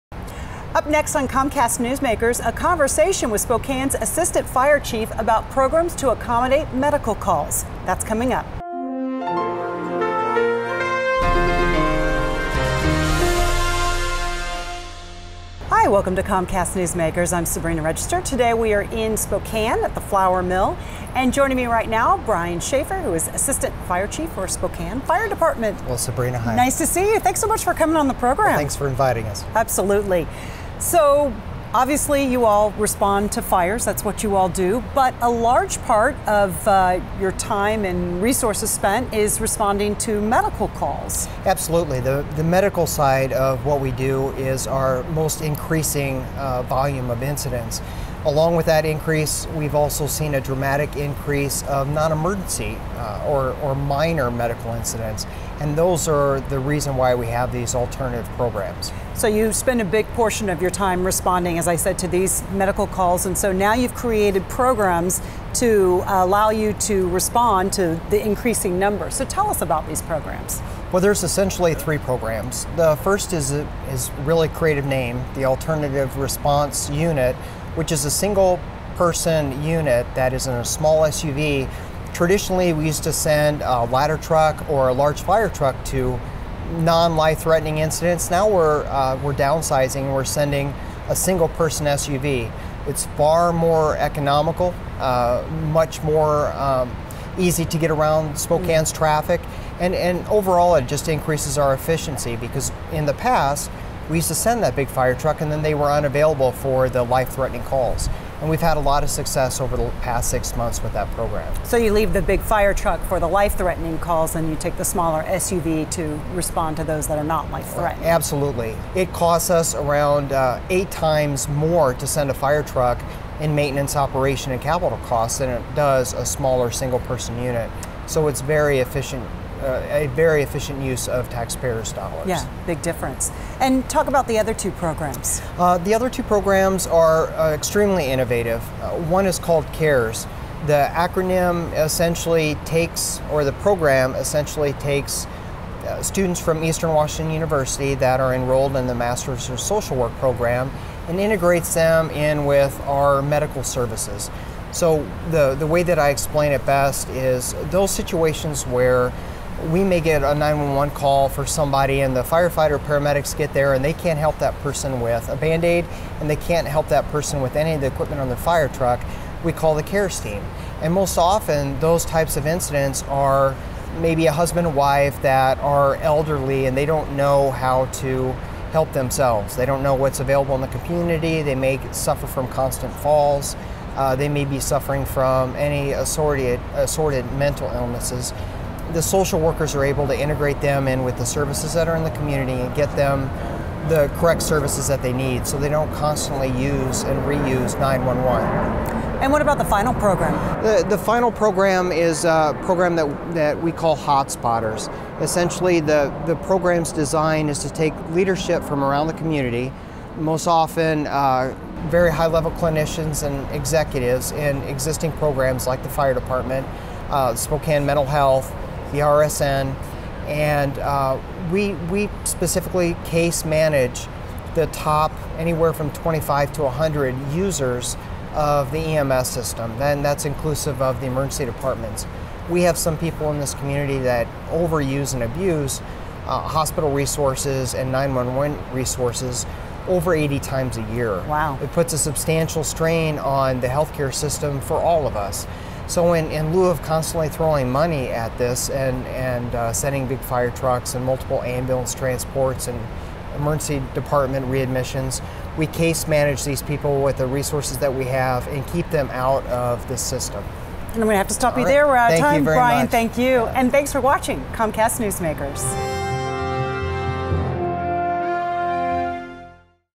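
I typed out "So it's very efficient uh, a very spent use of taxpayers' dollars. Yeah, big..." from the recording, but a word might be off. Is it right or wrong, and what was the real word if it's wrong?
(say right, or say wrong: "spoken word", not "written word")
wrong: "efficient", not "spent".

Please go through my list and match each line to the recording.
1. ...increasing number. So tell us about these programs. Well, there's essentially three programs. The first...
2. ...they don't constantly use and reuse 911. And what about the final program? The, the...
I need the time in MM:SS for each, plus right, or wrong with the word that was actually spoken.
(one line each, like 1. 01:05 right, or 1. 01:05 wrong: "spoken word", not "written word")
1. 01:08 right
2. 03:15 right.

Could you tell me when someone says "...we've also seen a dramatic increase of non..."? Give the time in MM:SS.
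00:49.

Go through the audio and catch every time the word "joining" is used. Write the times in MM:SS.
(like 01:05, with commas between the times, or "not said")
00:21.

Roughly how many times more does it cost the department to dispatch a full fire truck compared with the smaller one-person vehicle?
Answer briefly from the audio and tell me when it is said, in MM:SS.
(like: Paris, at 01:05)
8, at 02:00.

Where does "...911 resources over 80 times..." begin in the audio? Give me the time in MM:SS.
03:57.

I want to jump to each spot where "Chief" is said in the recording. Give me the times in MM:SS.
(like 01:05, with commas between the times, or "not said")
00:04, 00:24.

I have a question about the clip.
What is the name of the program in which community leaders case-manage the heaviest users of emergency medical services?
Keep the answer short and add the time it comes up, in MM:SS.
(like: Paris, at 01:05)
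Hotspotters, at 03:23.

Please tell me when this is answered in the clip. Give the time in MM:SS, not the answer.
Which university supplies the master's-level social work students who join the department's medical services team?
02:26.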